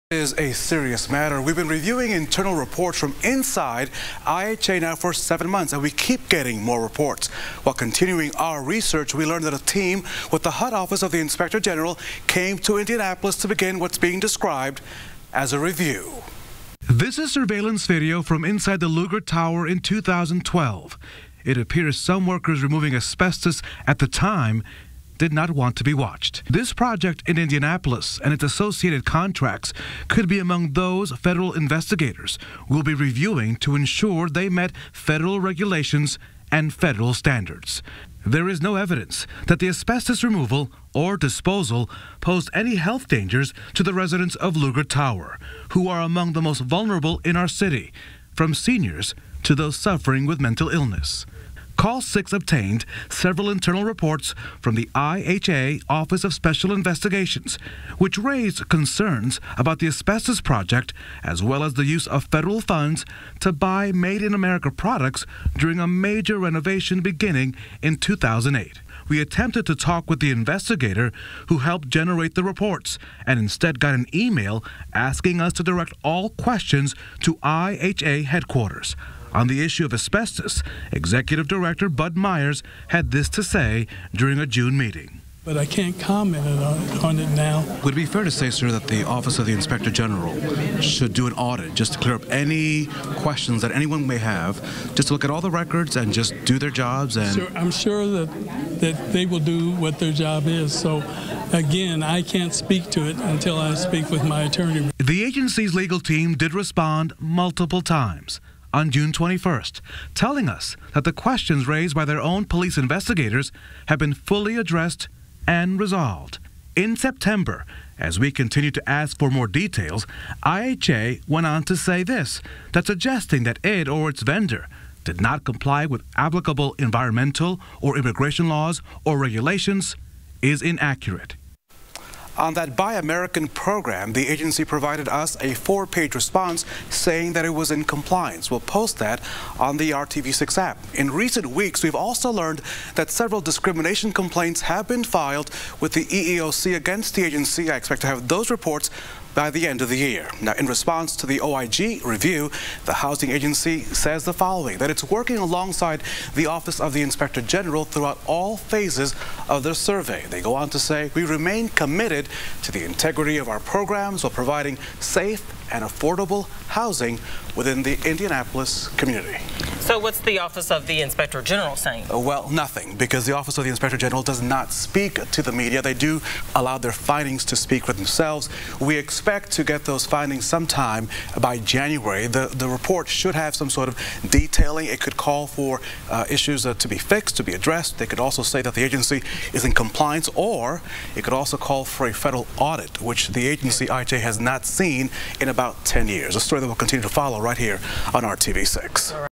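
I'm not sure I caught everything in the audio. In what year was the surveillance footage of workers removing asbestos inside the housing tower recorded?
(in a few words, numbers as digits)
2012.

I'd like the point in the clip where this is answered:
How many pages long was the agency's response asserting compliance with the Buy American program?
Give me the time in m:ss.
2:15.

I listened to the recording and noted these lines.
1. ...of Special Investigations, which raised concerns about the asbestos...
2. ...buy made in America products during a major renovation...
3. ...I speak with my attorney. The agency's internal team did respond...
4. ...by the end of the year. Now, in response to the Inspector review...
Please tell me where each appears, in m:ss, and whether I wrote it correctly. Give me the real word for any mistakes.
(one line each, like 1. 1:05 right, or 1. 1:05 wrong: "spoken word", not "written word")
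1. 0:56 right
2. 1:03 right
3. 1:43 wrong: "legal", not "internal"
4. 2:29 wrong: "OIG", not "Inspector".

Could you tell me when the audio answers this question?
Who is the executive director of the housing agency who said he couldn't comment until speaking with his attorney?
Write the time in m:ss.
1:21.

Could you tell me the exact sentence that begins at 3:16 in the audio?
A story that will continue to follow right here on RTV6.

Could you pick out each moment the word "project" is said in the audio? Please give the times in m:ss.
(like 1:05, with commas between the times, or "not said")
0:26, 1:00.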